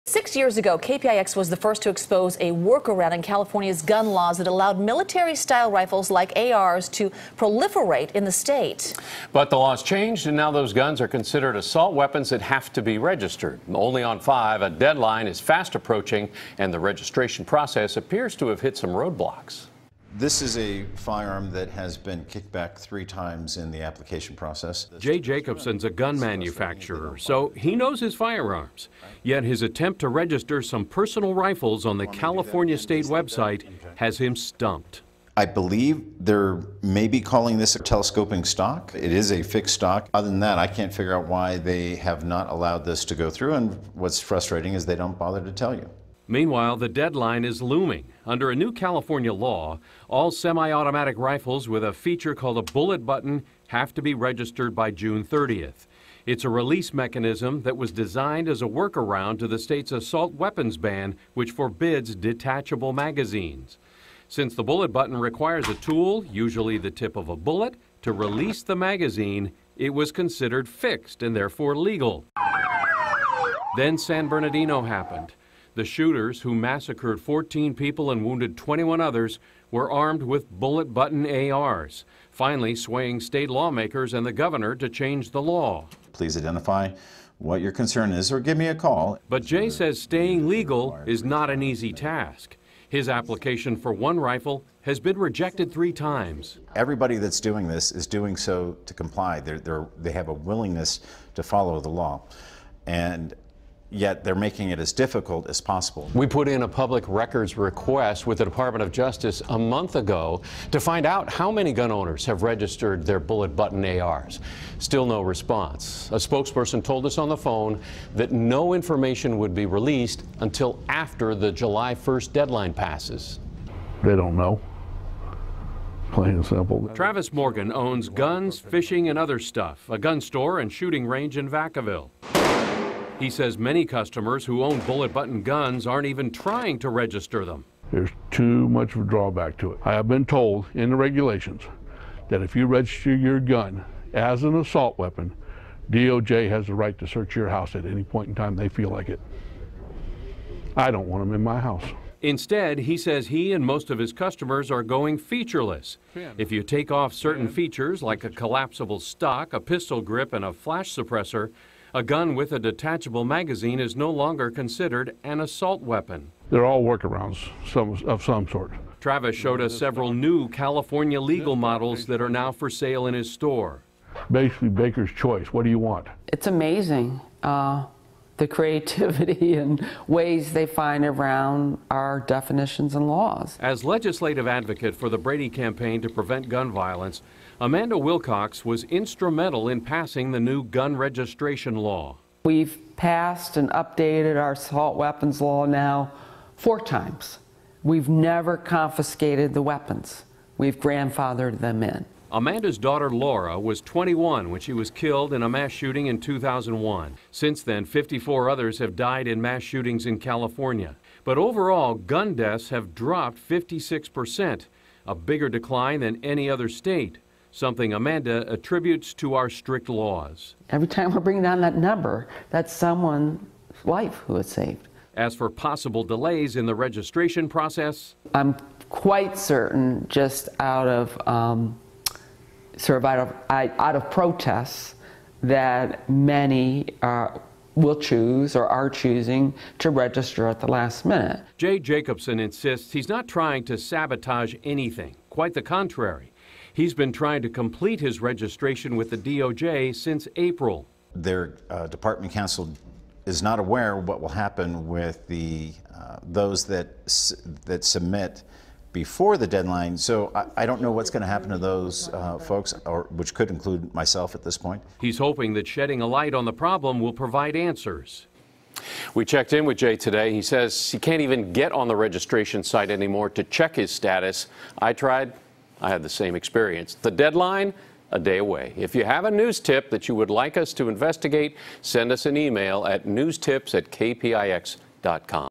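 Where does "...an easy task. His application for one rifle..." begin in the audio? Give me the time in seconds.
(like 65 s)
91 s.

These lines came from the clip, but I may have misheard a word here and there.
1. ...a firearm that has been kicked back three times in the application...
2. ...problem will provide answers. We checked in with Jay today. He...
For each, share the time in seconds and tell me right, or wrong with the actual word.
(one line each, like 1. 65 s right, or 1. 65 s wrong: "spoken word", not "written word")
1. 20 s right
2. 266 s right.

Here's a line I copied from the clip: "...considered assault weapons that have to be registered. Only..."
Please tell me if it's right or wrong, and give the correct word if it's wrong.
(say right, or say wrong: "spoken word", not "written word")
right.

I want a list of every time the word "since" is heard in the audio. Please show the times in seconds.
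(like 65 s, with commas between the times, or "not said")
64 s, 207 s, 249 s.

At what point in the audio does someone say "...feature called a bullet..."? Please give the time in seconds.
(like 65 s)
51 s.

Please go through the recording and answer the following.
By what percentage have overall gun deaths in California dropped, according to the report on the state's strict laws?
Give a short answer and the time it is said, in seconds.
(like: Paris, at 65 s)
56%, at 213 s.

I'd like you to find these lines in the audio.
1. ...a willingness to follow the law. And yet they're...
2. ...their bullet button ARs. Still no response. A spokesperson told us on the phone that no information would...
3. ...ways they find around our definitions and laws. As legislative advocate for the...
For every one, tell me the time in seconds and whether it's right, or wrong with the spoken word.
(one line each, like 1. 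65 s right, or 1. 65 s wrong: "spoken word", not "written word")
1. 100 s right
2. 113 s right
3. 180 s right.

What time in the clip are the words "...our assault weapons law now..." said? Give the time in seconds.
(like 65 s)
194 s.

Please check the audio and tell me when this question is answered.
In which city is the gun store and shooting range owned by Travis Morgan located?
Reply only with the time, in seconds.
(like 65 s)
131 s.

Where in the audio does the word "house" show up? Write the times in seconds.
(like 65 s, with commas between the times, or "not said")
147 s, 151 s.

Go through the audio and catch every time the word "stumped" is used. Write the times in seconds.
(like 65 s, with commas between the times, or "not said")
34 s.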